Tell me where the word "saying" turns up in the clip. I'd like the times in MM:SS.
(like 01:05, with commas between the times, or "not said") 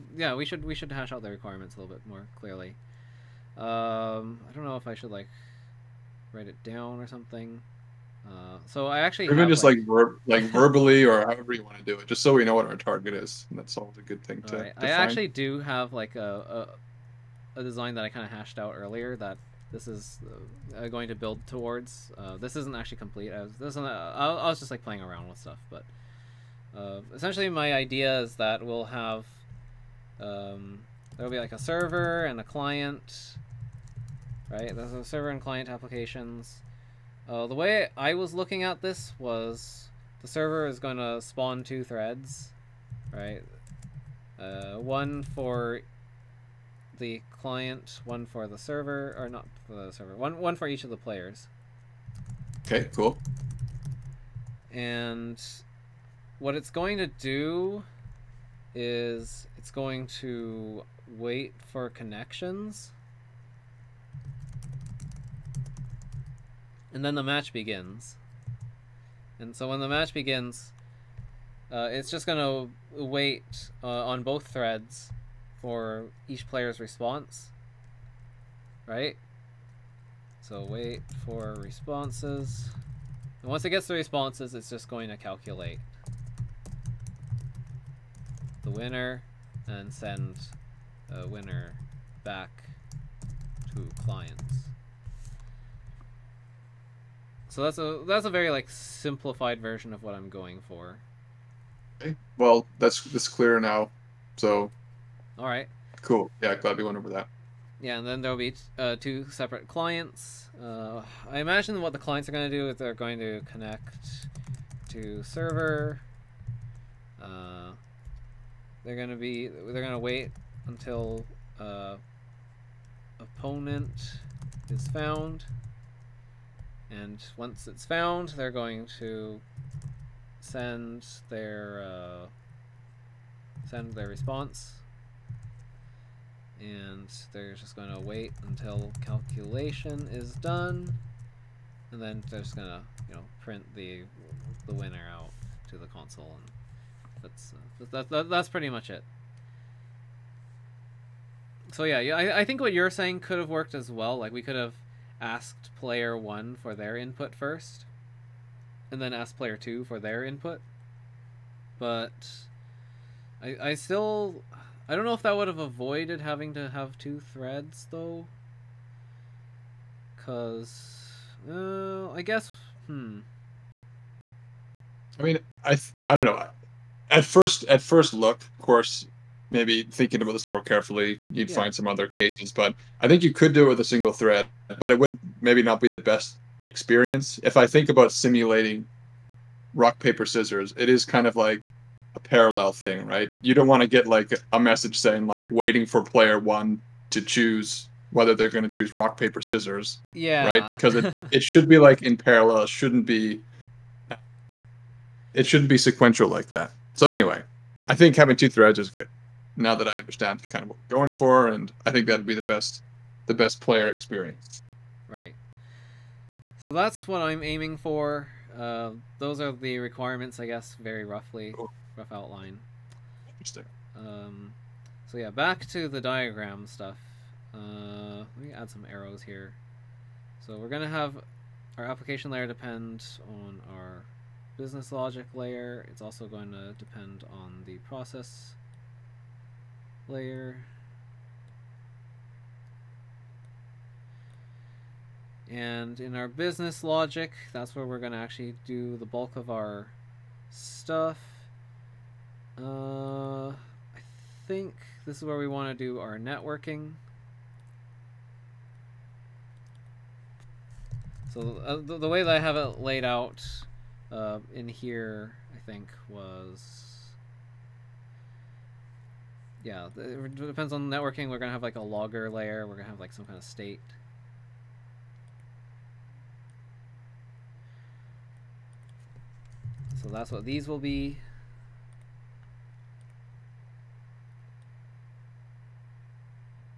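02:32, 03:14.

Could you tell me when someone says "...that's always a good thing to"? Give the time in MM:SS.
00:13.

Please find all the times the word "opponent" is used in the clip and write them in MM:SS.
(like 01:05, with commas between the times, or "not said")
02:03.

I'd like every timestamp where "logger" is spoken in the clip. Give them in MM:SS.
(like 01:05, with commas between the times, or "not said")
04:31.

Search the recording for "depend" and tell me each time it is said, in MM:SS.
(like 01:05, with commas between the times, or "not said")
03:52, 03:56, 04:30.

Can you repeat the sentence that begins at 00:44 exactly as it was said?
Uh, one for the client, one for the server, or not for the server, one, one for each of the players.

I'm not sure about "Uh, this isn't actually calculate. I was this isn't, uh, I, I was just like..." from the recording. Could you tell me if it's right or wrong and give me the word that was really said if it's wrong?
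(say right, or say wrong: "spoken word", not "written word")
wrong: "complete", not "calculate".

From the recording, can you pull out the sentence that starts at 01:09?
And so when the match begins, uh, it's just gonna wait uh, on both threads for each player's response, right?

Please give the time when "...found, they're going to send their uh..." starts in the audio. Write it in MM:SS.
02:07.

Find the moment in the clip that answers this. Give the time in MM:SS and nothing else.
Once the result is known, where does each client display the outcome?
02:25.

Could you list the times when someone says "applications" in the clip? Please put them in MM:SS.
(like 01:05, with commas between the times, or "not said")
00:35, 03:51.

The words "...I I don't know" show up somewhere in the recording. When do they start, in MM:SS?
02:55.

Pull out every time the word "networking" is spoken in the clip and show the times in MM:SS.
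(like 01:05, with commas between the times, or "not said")
04:16, 04:30.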